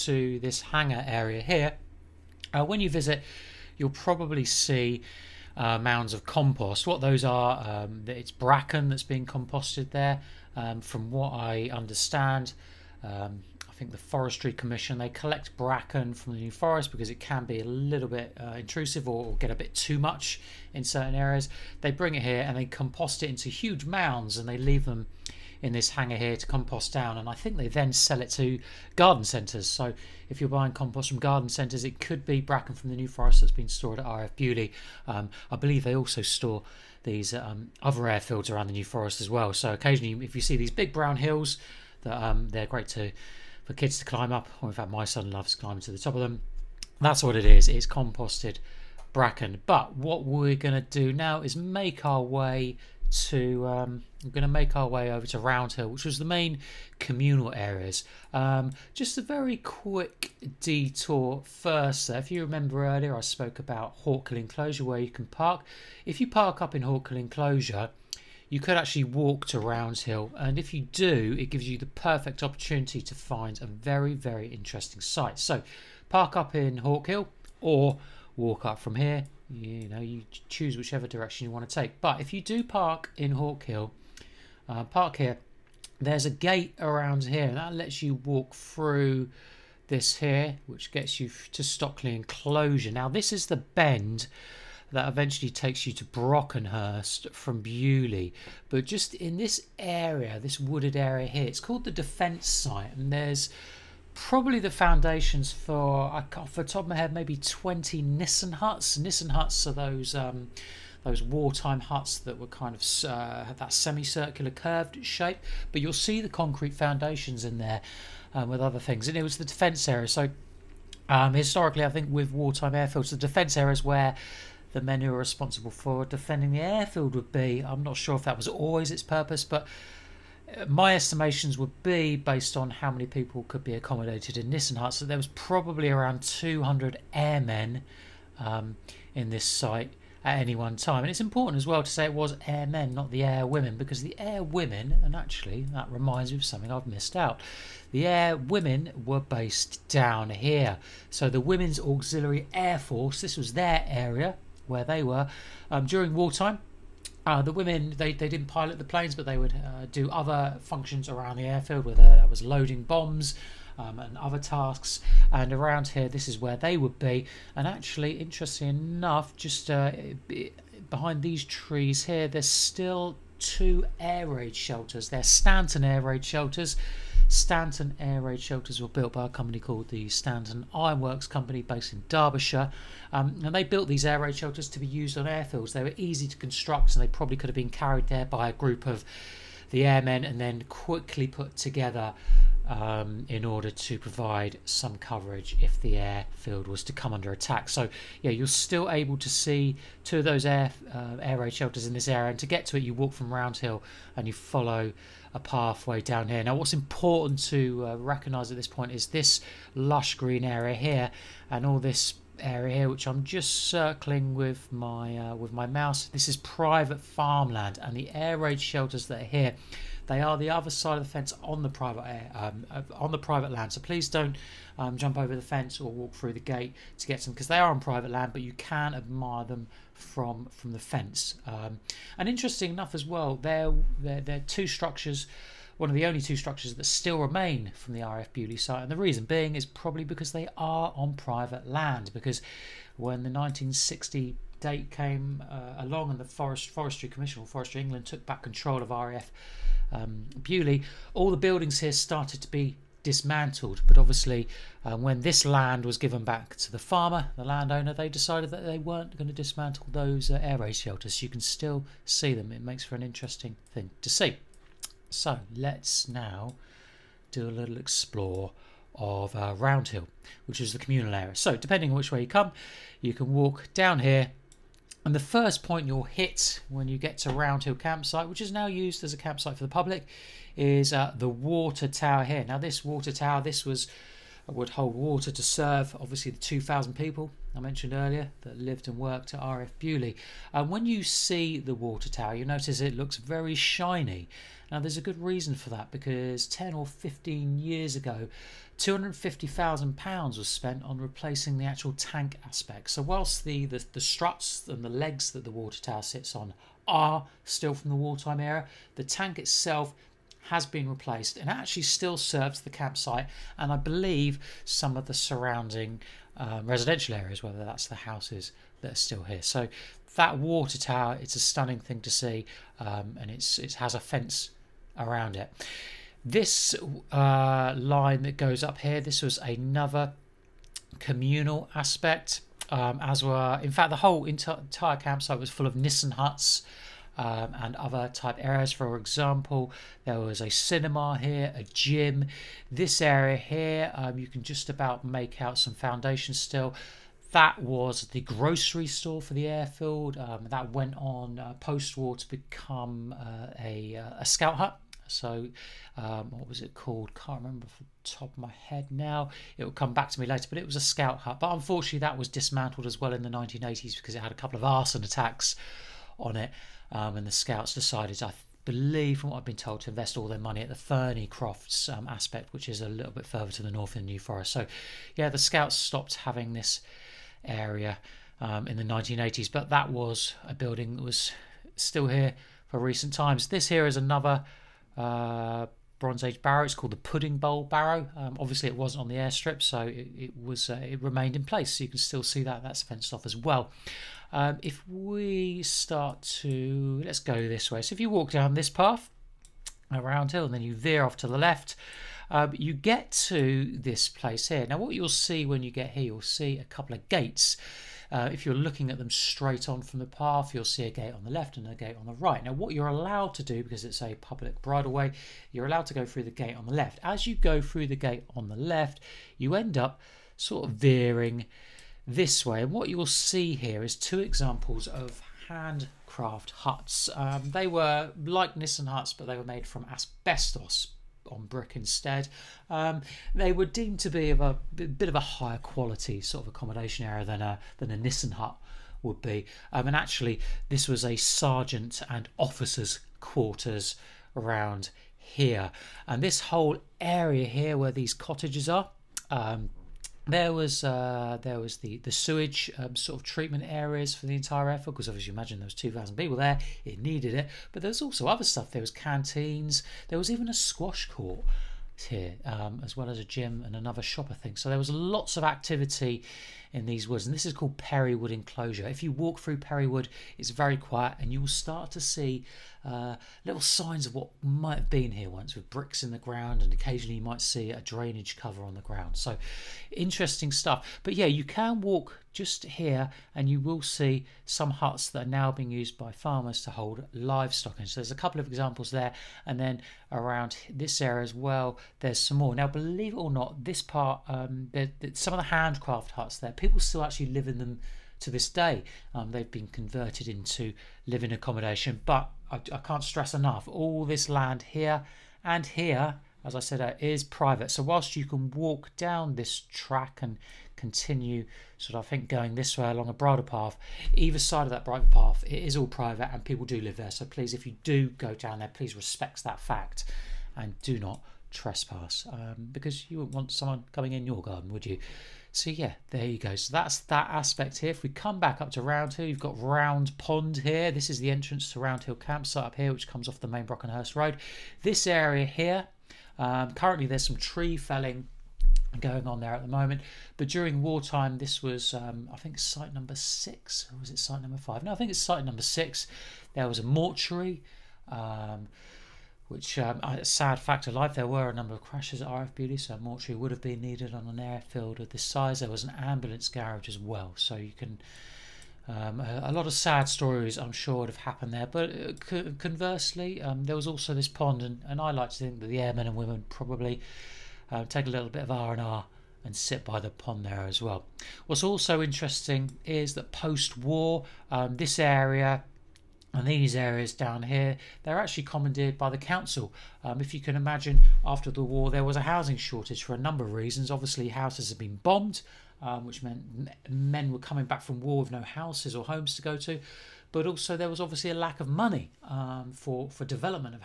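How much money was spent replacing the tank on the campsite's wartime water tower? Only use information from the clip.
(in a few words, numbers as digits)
£250,000.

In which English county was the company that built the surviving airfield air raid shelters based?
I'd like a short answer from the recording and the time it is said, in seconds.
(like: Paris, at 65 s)
Derbyshire, at 182 s.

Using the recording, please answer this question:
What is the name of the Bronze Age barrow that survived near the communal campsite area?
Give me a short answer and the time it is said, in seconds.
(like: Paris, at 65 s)
Pudding Bowl Barrow, at 386 s.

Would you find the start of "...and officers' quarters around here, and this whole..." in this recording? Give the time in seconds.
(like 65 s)
442 s.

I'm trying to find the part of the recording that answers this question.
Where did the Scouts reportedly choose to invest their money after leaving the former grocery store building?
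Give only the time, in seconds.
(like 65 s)
370 s.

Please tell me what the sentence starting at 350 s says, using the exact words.
Um, that went on uh, post war to become uh, a, uh, a scout hut.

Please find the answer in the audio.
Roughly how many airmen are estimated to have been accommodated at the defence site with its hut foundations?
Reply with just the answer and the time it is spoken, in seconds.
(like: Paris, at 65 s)
200, at 136 s.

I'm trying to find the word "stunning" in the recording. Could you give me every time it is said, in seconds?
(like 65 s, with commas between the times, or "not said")
321 s.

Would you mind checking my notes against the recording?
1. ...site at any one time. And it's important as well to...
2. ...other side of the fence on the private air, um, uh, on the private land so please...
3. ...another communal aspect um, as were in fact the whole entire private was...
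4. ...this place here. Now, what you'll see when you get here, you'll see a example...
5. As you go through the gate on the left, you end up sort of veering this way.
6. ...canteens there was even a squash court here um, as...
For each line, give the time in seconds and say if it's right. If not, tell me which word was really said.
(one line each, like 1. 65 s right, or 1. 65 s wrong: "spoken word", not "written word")
1. 139 s right
2. 220 s right
3. 329 s wrong: "campsite", not "private"
4. 403 s wrong: "couple", not "example"
5. 417 s right
6. 458 s right.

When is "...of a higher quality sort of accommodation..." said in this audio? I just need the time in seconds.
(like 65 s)
435 s.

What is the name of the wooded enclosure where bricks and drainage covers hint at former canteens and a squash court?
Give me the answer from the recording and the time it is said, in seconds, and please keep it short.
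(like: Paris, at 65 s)
Perrywood Enclosure, at 467 s.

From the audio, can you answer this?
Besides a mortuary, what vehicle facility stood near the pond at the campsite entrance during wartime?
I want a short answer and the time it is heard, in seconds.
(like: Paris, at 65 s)
Ambulance garage, at 555 s.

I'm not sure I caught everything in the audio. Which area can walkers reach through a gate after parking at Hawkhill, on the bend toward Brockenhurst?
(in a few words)
Stockley Enclosure.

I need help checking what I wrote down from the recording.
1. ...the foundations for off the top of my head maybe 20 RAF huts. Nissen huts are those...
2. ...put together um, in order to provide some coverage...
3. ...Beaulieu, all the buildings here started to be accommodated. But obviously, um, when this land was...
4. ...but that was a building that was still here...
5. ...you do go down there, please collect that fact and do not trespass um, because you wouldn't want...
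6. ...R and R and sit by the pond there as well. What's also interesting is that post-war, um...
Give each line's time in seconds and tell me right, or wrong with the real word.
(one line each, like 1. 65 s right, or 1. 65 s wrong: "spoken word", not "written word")
1. 104 s wrong: "Nissen", not "RAF"
2. 191 s right
3. 250 s wrong: "dismantled", not "accommodated"
4. 379 s right
5. 517 s wrong: "respect", not "collect"
6. 568 s right.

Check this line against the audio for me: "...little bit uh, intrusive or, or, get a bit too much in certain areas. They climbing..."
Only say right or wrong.
wrong.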